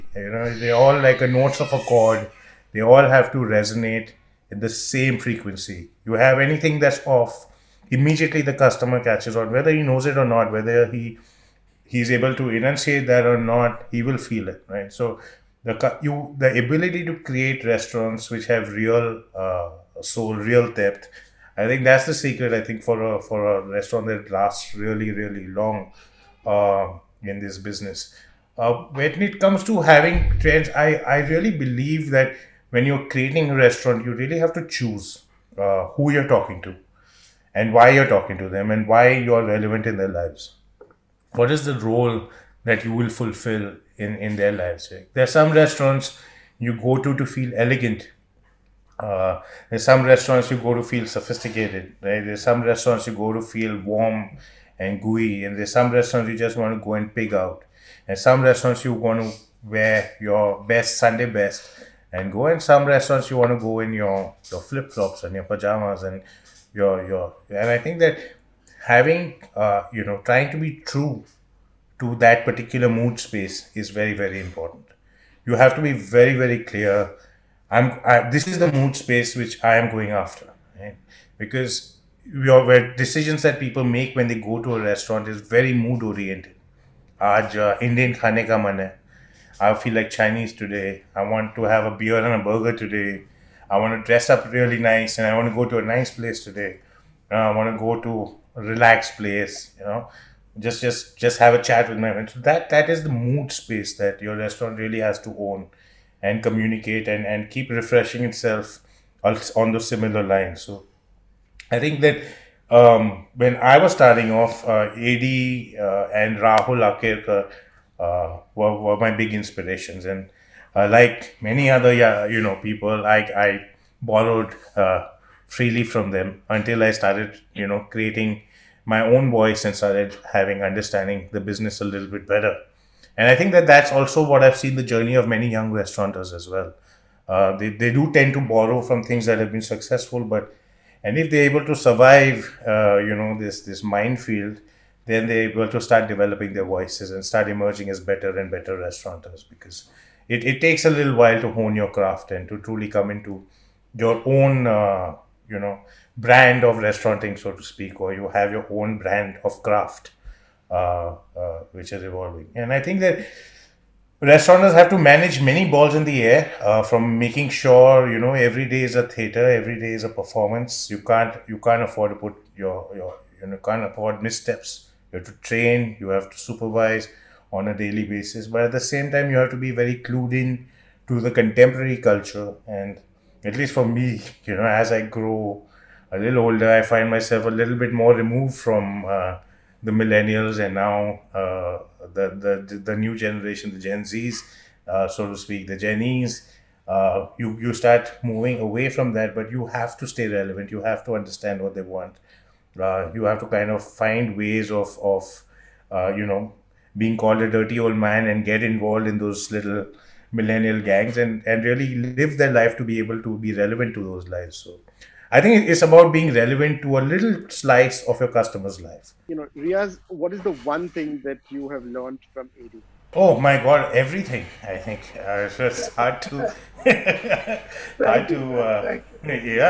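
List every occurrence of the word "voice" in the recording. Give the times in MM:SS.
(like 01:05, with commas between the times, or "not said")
02:09, 02:26.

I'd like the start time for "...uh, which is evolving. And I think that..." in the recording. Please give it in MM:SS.
02:41.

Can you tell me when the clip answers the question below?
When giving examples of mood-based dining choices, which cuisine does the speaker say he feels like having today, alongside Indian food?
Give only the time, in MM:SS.
01:30.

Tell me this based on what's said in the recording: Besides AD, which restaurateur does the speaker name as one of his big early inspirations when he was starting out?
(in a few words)
Rahul Akerkar.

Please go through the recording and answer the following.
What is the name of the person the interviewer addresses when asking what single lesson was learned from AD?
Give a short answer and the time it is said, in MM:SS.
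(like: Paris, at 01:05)
Riyaaz, at 03:39.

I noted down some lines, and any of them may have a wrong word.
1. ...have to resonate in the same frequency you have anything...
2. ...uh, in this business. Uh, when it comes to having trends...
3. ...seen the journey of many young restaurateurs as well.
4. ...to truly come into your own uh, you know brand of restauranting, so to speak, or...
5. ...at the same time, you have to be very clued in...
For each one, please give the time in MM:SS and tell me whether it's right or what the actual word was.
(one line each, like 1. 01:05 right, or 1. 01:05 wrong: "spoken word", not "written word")
1. 00:03 right
2. 00:26 right
3. 02:14 right
4. 02:32 right
5. 02:58 right.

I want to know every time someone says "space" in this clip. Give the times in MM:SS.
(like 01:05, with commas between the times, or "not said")
01:13, 01:19, 01:43.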